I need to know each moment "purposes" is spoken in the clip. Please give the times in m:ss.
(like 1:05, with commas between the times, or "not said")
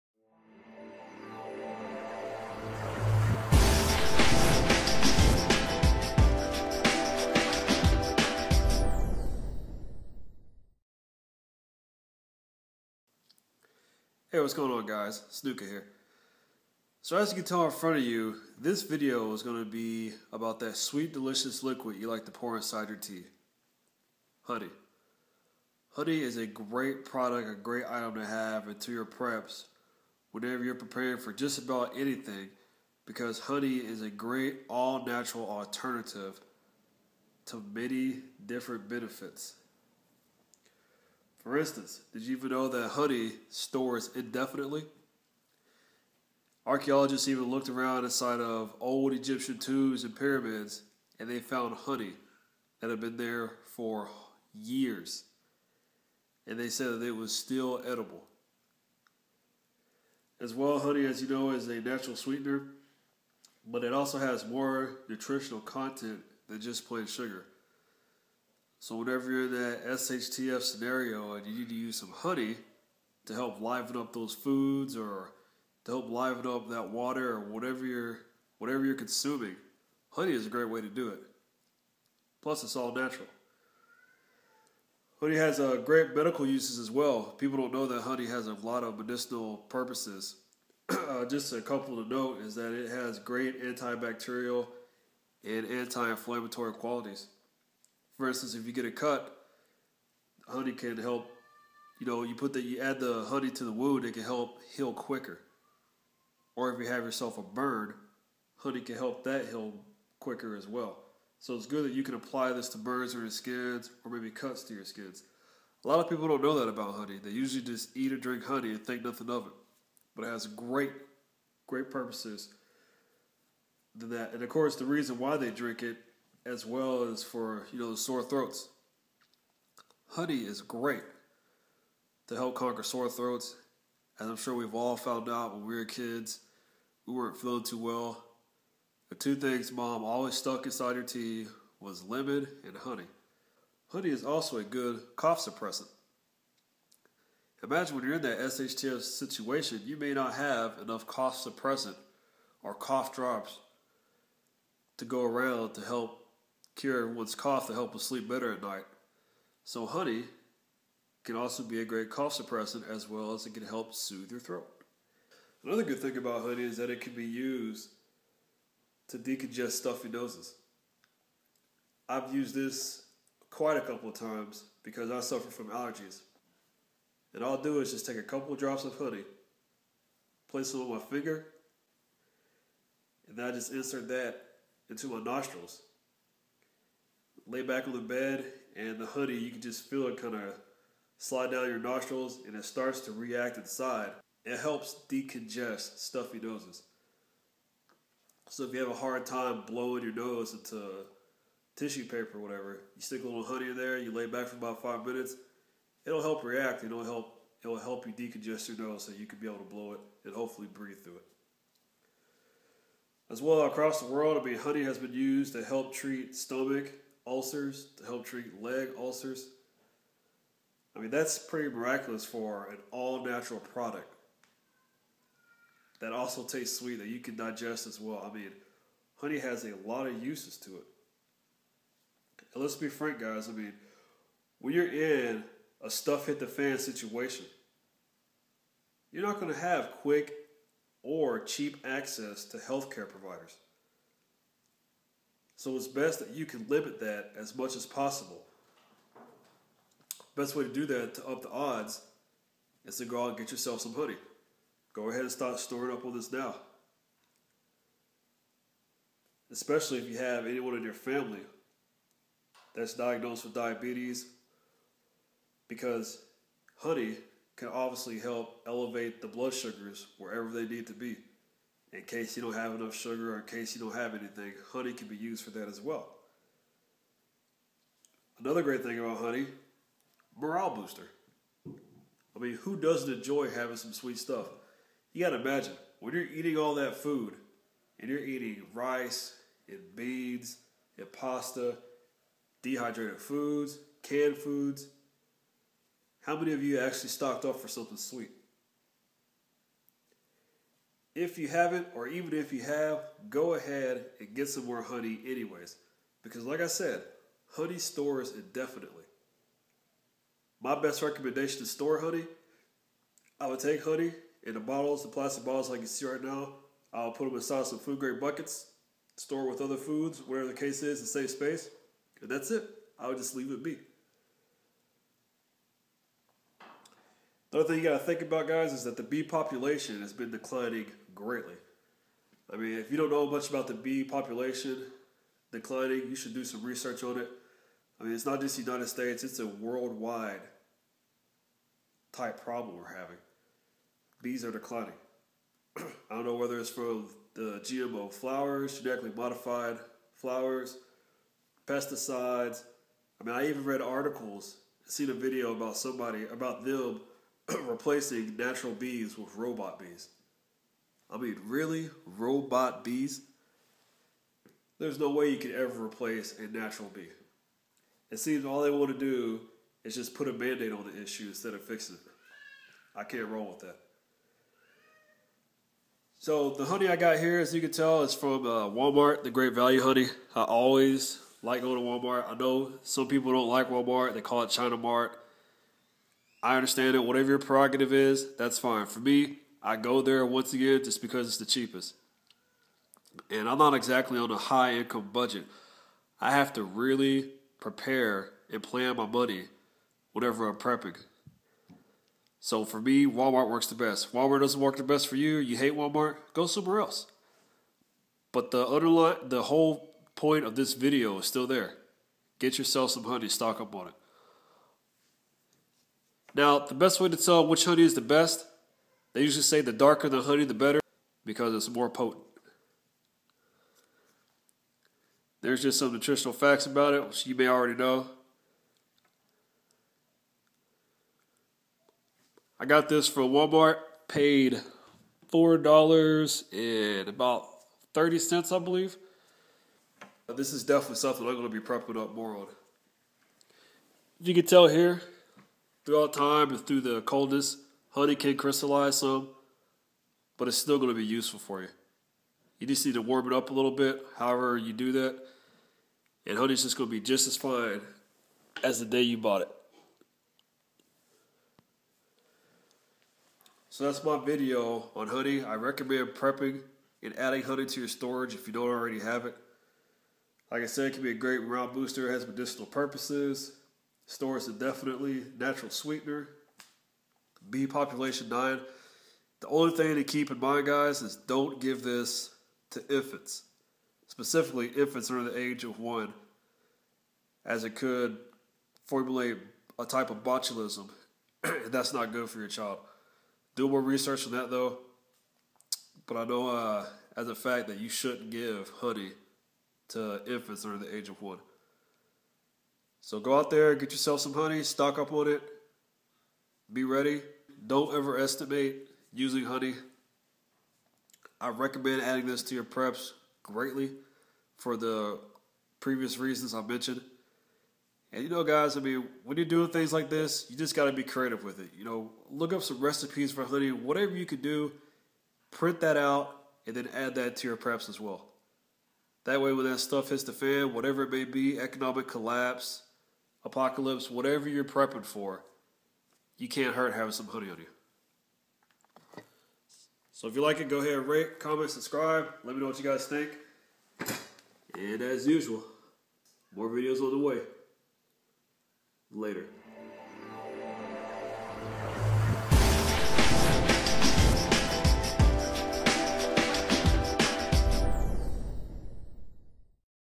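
1:29, 2:01, 7:52.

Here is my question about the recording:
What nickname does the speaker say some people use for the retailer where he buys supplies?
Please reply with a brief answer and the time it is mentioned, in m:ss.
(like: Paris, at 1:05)
China Mart, at 6:24.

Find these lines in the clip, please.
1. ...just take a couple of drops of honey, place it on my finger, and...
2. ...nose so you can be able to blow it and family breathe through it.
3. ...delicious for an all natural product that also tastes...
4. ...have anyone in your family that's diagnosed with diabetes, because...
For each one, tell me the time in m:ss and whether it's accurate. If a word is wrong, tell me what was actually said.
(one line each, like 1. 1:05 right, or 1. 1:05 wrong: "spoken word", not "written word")
1. 2:57 right
2. 3:28 wrong: "hopefully", not "family"
3. 3:41 wrong: "miraculous", not "delicious"
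4. 4:20 right.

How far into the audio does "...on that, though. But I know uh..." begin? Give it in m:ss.
8:14.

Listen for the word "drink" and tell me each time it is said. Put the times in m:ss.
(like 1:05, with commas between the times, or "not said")
1:58, 2:05.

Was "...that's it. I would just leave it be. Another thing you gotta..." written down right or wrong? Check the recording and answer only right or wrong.
right.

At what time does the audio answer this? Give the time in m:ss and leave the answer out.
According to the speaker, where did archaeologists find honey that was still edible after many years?
0:48.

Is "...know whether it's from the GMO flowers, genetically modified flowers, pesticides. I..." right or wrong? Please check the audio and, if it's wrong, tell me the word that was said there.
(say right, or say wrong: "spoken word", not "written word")
right.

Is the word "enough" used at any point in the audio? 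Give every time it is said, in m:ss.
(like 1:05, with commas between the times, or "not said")
2:30, 4:32.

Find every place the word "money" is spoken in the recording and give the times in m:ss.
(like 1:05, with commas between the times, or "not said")
6:39.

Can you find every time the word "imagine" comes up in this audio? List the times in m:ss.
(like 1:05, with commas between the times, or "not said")
2:27, 4:45.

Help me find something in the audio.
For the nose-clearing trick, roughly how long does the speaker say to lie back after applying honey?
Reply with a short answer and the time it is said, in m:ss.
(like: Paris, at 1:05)
5 minutes, at 3:24.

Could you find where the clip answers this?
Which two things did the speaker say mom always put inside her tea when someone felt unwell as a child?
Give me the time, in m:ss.
2:22.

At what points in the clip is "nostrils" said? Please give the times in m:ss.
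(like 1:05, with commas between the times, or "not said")
3:05, 3:11.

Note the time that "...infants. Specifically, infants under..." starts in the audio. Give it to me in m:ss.
8:02.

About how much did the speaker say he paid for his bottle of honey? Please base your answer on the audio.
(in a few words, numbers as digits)
$4.30.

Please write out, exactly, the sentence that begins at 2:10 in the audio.
Honey is great to help conquer sore throats, as I'm sure we've all found out when we were kids.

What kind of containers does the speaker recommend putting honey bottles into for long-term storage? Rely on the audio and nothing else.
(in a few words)
food grade buckets.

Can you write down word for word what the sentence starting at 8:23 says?
So go out there, get yourself some honey, stock up on it, be ready.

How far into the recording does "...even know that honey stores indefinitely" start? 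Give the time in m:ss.
0:42.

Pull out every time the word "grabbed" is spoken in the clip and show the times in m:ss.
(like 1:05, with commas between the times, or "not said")
not said.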